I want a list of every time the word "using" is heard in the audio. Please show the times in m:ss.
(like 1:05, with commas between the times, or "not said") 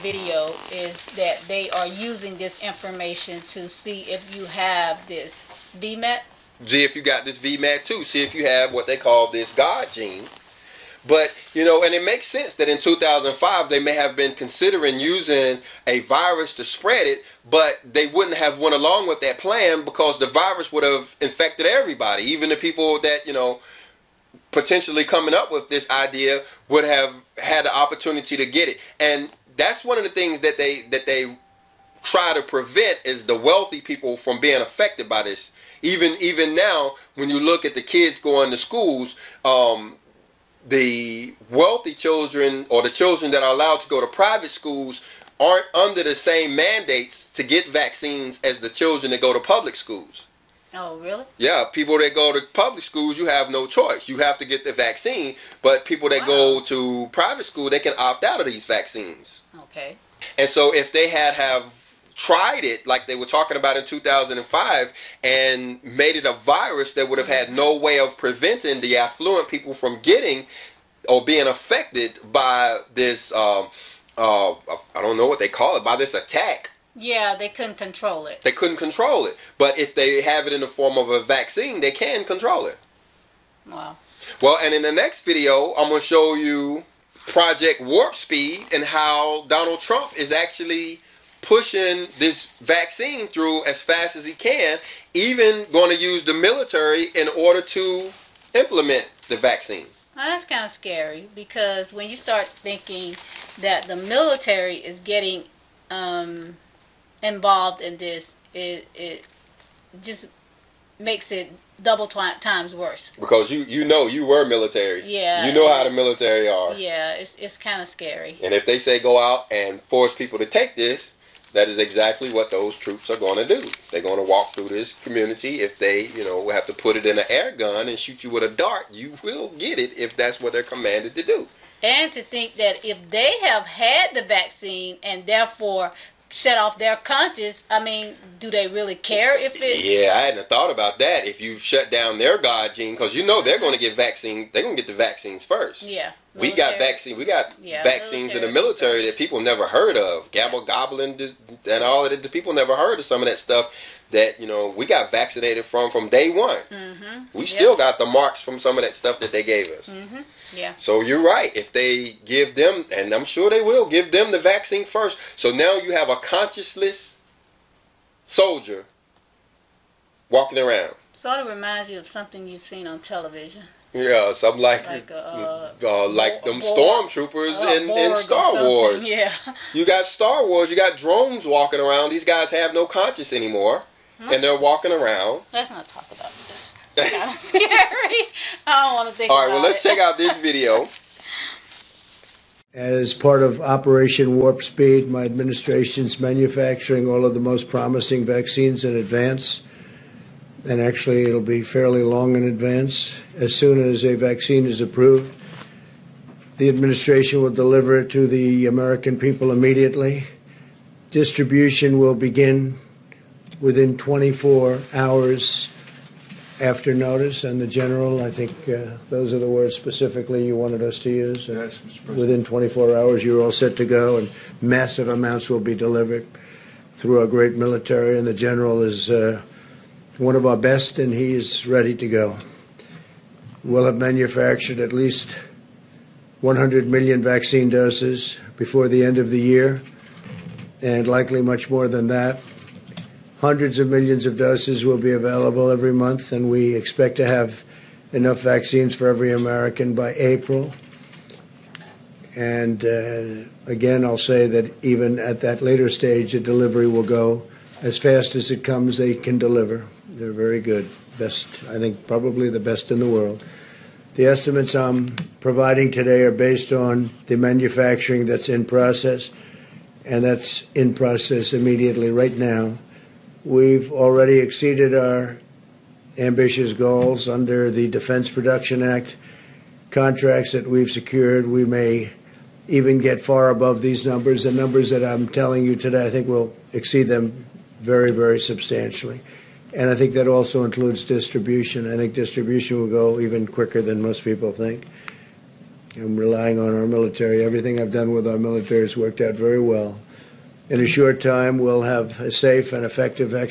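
0:01, 0:14.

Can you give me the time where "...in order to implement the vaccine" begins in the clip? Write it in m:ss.
1:37.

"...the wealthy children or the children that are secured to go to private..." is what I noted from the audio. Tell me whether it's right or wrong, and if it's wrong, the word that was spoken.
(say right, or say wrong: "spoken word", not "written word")
wrong: "allowed", not "secured".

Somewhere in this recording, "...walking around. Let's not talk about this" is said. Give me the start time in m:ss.
3:04.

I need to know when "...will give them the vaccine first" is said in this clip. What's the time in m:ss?
2:43.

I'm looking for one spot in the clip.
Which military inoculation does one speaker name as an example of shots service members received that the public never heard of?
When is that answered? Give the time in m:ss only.
2:30.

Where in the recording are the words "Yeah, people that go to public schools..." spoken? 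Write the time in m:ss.
0:51.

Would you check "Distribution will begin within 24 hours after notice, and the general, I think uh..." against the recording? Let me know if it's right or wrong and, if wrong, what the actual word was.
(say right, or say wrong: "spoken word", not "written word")
right.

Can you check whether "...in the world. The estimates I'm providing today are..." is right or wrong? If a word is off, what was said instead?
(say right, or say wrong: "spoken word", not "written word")
right.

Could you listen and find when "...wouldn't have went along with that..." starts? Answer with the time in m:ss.
0:18.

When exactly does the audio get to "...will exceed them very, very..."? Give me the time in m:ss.
4:46.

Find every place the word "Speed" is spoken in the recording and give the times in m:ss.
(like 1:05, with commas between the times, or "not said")
1:28, 3:14.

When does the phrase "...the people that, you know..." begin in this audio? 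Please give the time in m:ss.
0:22.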